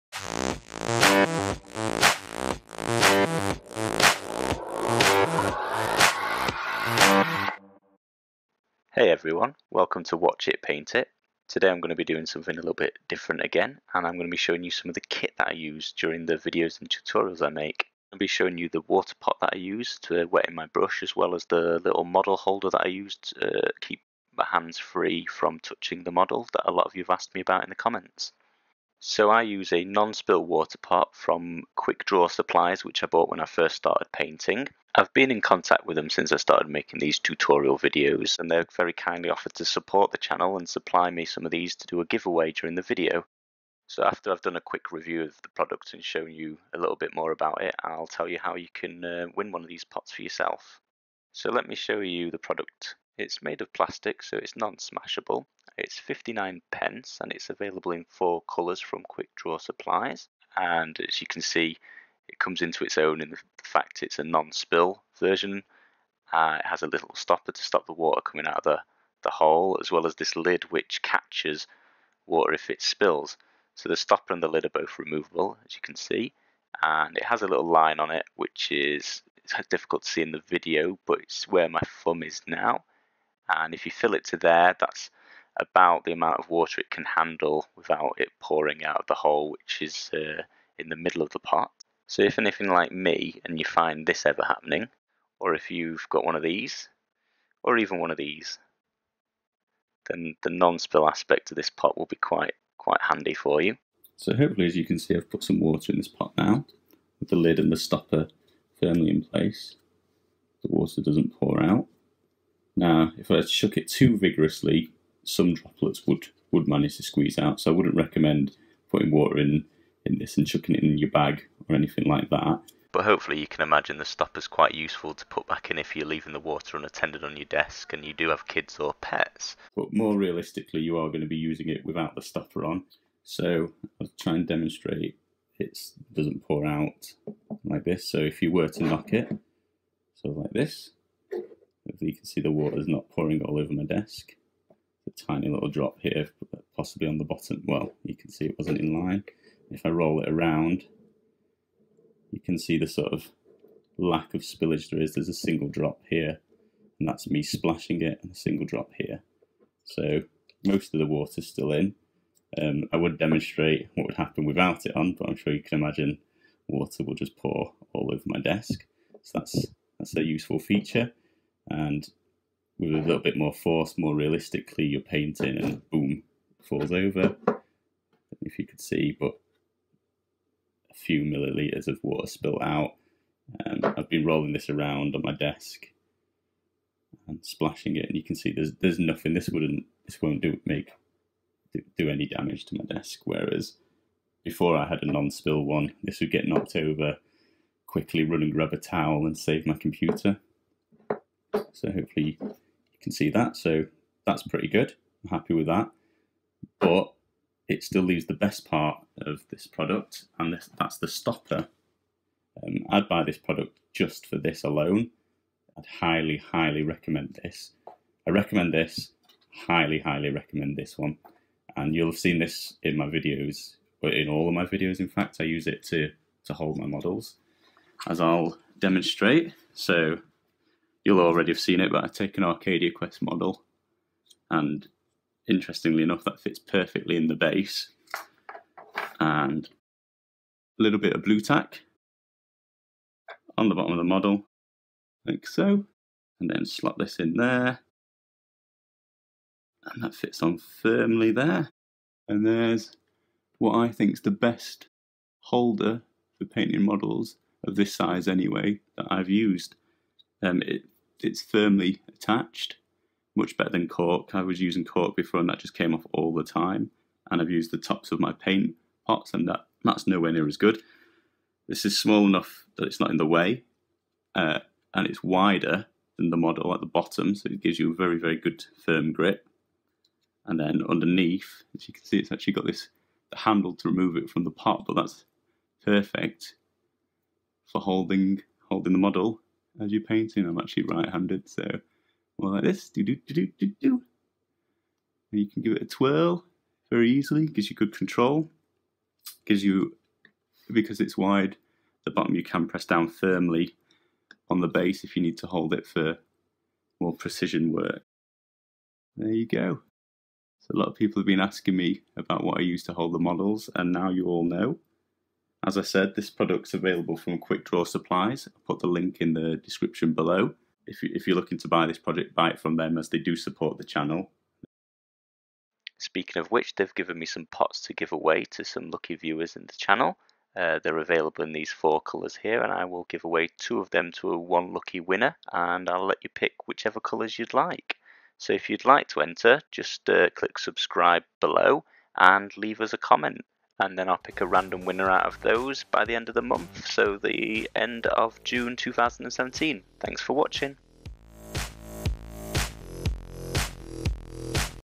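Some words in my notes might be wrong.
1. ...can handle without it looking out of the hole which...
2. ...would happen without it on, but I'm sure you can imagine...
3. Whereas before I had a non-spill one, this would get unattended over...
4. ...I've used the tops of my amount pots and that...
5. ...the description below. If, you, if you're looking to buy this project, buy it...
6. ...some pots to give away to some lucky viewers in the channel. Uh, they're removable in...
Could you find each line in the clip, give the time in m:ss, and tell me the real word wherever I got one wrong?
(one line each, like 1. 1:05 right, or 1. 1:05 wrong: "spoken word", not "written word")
1. 1:26 wrong: "pouring", not "looking"
2. 2:44 right
3. 3:13 wrong: "knocked", not "unattended"
4. 4:27 wrong: "paint", not "amount"
5. 5:19 right
6. 5:27 wrong: "available", not "removable".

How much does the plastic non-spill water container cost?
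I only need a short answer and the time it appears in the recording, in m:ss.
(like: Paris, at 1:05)
59 pence, at 0:55.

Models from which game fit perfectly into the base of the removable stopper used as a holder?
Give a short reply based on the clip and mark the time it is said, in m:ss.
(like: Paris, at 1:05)
Arcadia Quest, at 3:52.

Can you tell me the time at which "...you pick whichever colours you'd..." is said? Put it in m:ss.
5:36.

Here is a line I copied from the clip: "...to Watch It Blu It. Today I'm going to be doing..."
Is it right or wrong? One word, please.
wrong.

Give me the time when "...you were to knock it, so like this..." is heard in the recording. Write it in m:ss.
2:18.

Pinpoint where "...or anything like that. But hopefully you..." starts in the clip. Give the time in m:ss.
2:01.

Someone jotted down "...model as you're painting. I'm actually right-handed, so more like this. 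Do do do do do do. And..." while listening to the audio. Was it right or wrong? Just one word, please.
right.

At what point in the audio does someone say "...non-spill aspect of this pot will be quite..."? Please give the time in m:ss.
1:40.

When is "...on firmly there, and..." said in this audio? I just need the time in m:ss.
4:10.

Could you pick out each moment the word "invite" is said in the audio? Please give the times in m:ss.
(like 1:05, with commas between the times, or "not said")
not said.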